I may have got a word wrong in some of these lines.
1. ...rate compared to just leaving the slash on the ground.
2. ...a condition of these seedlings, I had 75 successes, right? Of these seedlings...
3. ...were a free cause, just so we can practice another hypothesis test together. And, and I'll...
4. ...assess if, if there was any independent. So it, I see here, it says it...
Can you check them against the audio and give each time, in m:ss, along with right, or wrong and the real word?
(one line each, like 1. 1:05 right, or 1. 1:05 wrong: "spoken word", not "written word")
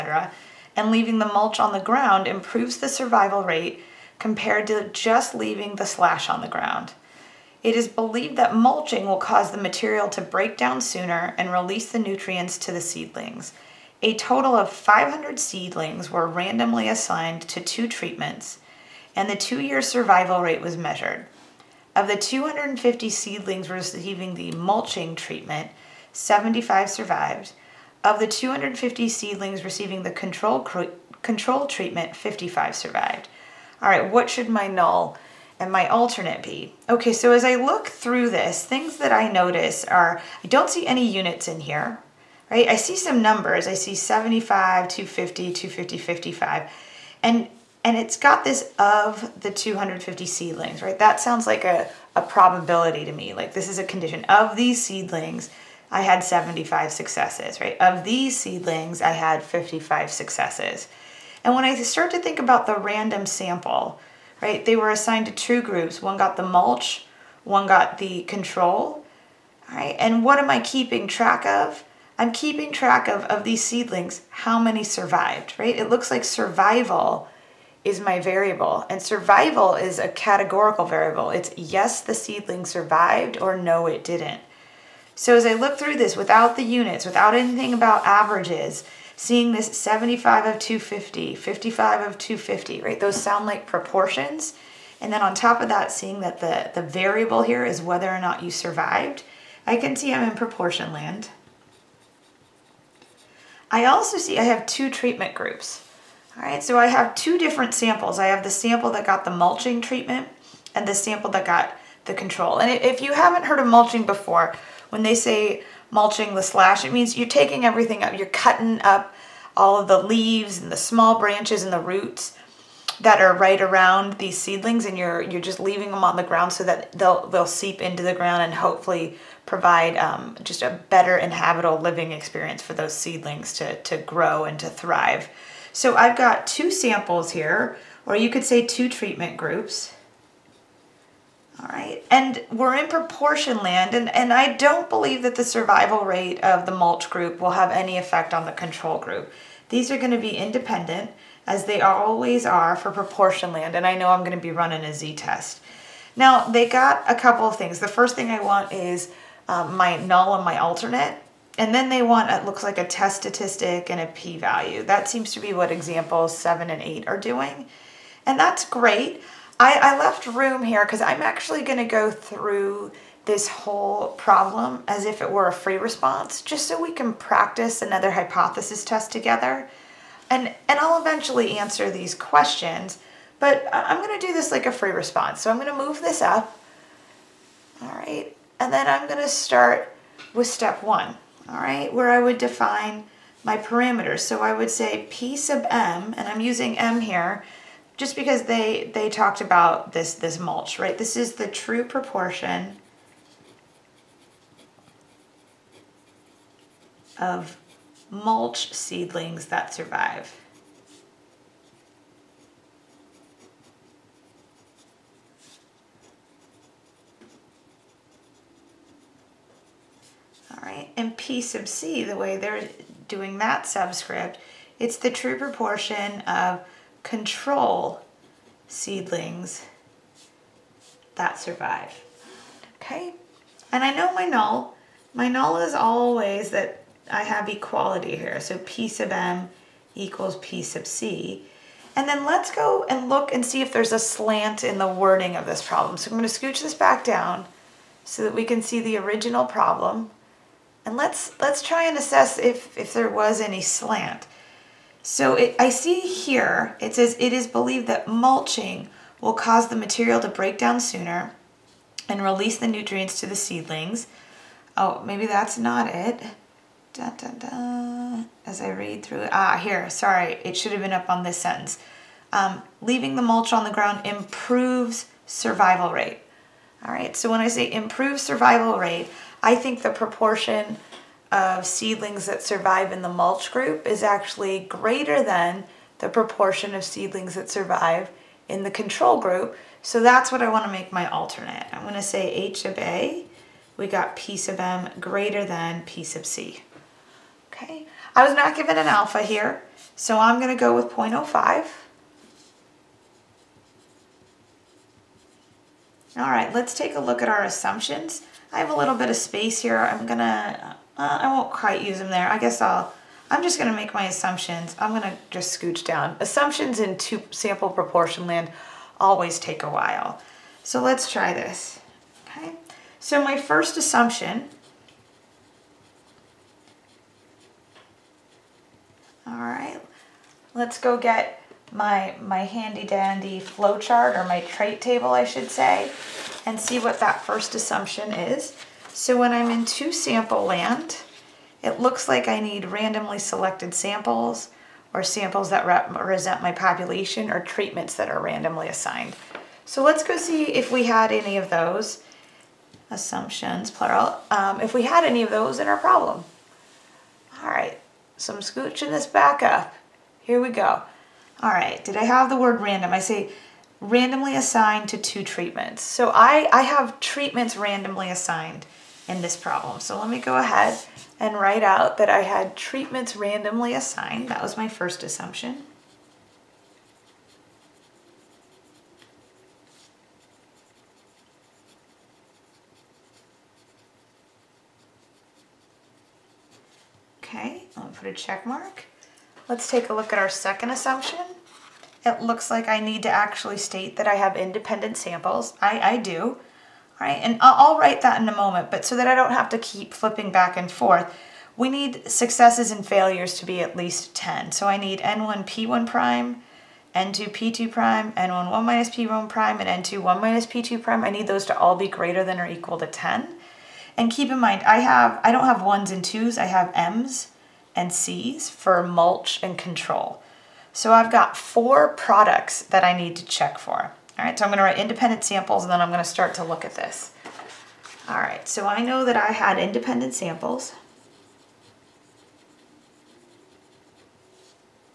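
1. 0:03 right
2. 0:53 right
3. 2:55 wrong: "response", not "cause"
4. 4:11 wrong: "slant", not "independent".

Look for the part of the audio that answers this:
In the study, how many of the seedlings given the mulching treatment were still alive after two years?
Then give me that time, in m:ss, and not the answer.
0:26.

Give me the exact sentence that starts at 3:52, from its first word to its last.
Okay, and I know my null.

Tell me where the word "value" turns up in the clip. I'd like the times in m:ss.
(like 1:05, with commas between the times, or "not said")
2:44.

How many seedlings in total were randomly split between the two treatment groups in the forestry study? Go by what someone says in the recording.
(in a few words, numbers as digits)
500.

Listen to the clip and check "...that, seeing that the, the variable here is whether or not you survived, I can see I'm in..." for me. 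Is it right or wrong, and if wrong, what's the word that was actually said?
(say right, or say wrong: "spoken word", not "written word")
right.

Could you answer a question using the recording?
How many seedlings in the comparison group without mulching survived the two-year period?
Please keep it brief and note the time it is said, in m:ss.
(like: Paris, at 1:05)
55, at 0:32.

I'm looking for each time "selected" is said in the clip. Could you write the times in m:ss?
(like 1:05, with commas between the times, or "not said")
5:43.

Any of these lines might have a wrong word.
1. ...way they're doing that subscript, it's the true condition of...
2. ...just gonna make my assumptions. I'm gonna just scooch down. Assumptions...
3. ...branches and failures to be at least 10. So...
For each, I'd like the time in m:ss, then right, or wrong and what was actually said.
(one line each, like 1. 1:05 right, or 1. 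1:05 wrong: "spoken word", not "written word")
1. 3:42 wrong: "proportion", not "condition"
2. 5:13 right
3. 6:42 wrong: "successes", not "branches".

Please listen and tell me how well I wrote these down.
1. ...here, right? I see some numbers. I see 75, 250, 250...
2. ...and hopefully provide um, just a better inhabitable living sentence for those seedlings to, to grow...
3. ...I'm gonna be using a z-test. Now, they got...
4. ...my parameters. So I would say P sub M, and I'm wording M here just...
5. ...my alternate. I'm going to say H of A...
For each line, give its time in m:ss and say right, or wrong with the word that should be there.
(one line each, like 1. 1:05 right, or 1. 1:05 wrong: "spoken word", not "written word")
1. 0:41 right
2. 2:08 wrong: "experience", not "sentence"
3. 2:34 wrong: "running", not "using"
4. 3:13 wrong: "using", not "wording"
5. 4:50 right.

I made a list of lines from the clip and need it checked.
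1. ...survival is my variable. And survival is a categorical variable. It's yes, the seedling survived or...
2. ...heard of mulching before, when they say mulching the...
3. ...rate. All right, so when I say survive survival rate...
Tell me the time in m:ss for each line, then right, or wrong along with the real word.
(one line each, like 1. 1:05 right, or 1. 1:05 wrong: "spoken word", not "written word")
1. 1:16 right
2. 1:53 right
3. 4:35 wrong: "improve", not "survive".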